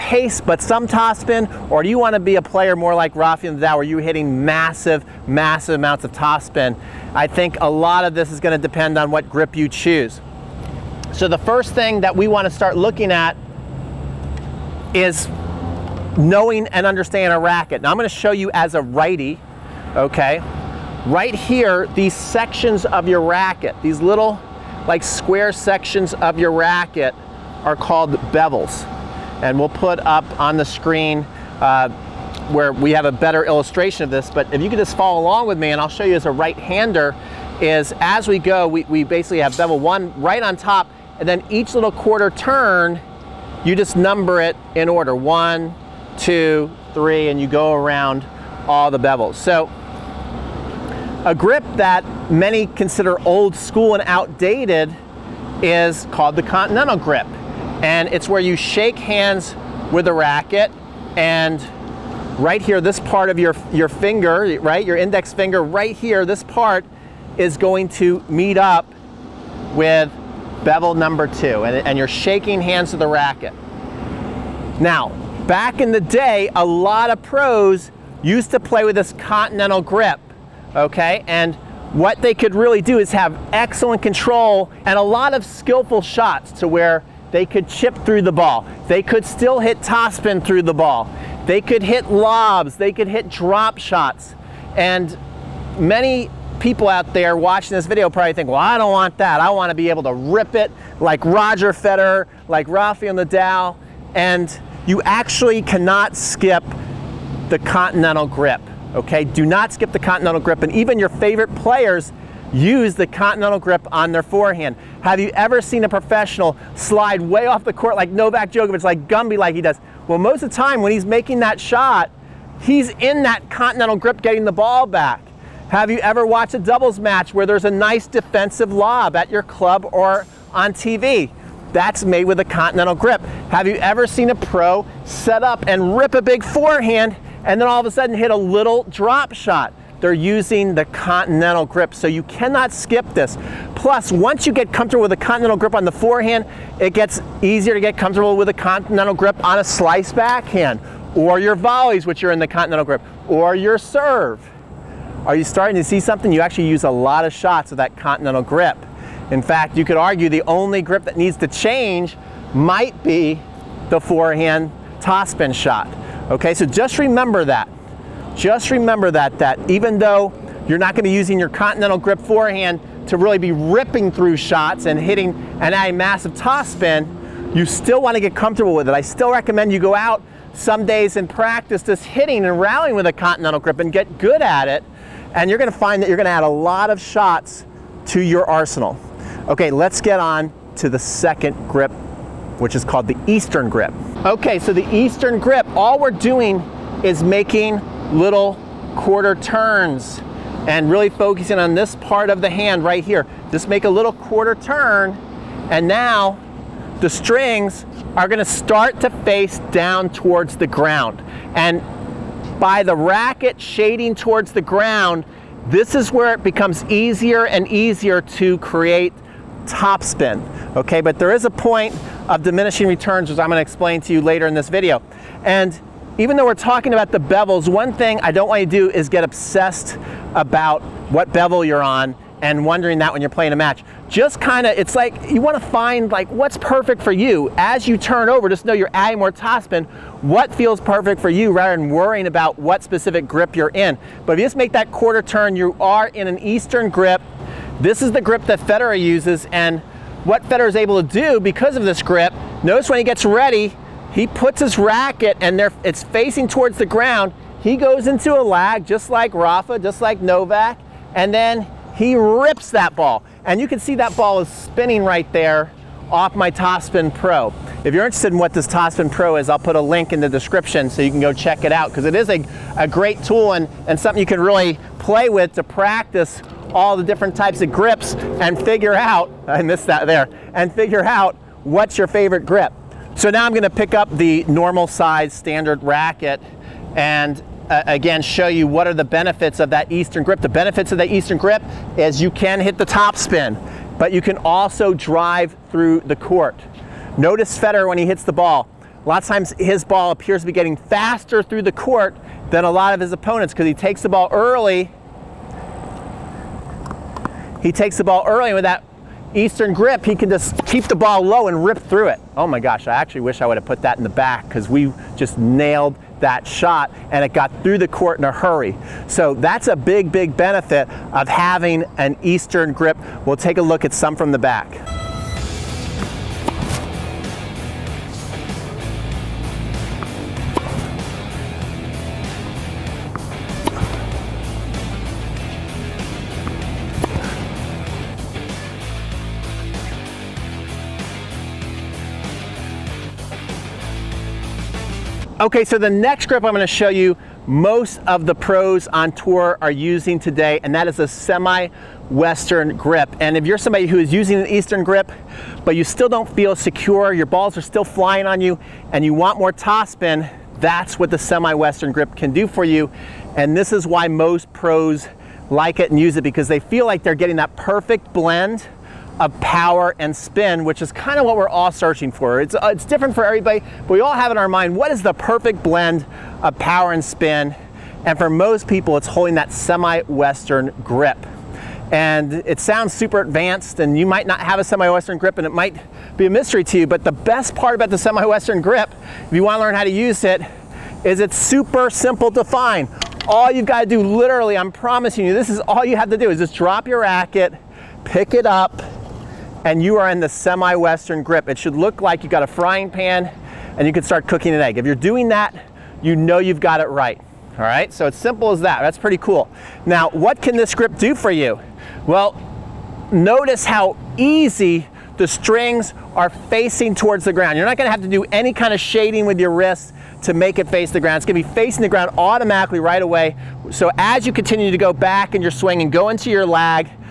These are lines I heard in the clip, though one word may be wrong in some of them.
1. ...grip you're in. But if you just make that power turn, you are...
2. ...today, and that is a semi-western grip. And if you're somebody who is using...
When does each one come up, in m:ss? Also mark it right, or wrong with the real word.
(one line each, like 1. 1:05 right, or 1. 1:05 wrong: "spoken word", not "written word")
1. 4:03 wrong: "quarter", not "power"
2. 5:50 right.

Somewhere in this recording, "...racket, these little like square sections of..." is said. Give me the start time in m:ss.
0:23.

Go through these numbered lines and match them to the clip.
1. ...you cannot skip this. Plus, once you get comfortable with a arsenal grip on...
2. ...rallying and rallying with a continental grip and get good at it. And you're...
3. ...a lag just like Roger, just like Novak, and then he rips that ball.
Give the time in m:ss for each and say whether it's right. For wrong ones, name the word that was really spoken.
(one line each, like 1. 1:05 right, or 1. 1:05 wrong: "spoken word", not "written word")
1. 2:22 wrong: "continental", not "arsenal"
2. 3:02 wrong: "hitting", not "rallying"
3. 4:18 wrong: "Rafa", not "Roger".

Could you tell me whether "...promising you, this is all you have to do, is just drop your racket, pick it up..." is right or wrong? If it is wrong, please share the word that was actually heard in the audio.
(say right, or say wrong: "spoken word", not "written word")
right.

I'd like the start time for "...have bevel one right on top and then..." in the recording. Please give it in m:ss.
0:39.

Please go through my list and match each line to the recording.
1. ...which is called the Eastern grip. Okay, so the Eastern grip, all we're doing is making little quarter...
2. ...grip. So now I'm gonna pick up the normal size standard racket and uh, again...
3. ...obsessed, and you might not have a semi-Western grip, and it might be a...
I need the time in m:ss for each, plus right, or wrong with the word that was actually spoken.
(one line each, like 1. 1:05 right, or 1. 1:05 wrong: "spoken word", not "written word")
1. 3:12 right
2. 4:42 right
3. 6:23 wrong: "advanced", not "obsessed".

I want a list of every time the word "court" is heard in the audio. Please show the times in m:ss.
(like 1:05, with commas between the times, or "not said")
1:57, 4:56, 5:01, 5:17.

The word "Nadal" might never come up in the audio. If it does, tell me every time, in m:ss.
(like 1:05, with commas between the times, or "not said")
0:03, 1:43.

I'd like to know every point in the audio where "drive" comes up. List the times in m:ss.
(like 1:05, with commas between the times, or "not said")
4:54.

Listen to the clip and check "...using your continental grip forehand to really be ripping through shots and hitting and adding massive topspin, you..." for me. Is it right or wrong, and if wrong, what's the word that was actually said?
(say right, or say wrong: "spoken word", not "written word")
right.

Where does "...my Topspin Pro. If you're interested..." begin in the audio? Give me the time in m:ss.
4:26.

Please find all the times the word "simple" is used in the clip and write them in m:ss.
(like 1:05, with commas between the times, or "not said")
6:31, 6:48.